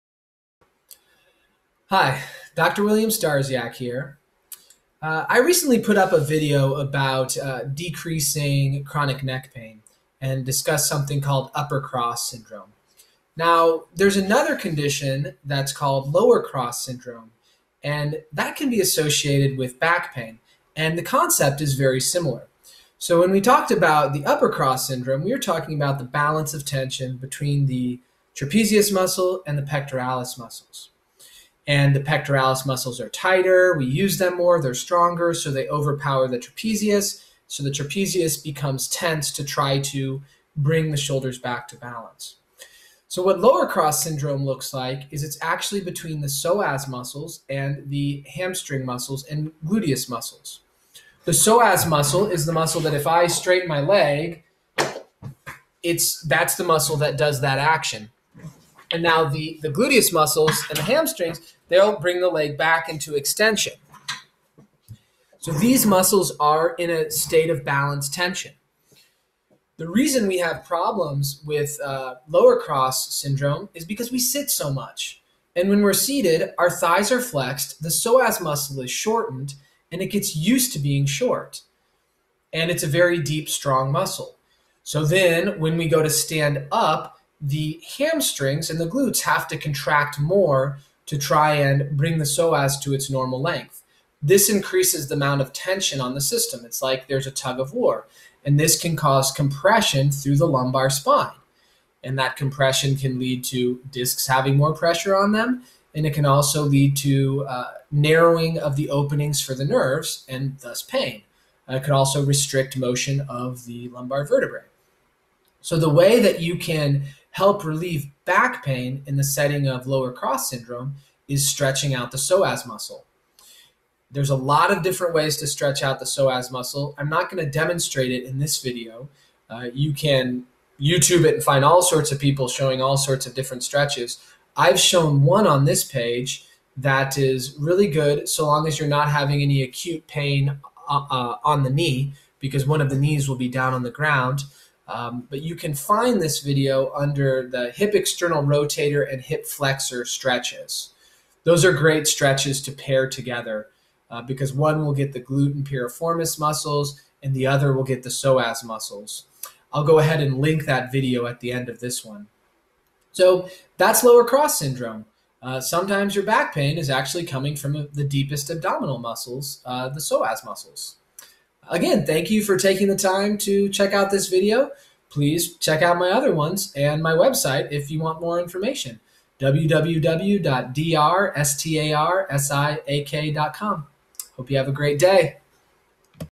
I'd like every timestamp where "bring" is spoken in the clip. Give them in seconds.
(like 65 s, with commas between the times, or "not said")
40 s, 61 s, 91 s.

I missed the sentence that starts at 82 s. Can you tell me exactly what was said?
And it's a very deep, strong muscle.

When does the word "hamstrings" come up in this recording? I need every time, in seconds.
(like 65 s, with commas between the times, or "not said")
48 s, 60 s, 87 s.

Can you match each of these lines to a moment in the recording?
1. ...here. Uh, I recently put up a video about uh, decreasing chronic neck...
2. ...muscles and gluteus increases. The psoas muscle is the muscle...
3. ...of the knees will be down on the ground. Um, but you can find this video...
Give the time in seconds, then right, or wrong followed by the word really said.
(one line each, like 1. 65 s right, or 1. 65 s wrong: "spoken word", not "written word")
1. 3 s right
2. 48 s wrong: "muscles", not "increases"
3. 142 s right.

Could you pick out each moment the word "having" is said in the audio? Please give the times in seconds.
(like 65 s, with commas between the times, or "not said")
104 s, 139 s.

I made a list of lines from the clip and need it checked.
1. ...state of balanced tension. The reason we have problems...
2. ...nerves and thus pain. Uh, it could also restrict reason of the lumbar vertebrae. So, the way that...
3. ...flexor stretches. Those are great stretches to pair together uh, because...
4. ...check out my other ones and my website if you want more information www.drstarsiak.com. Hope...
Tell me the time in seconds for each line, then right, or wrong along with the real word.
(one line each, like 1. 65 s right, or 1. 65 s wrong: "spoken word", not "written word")
1. 67 s right
2. 109 s wrong: "motion", not "reason"
3. 149 s right
4. 175 s right.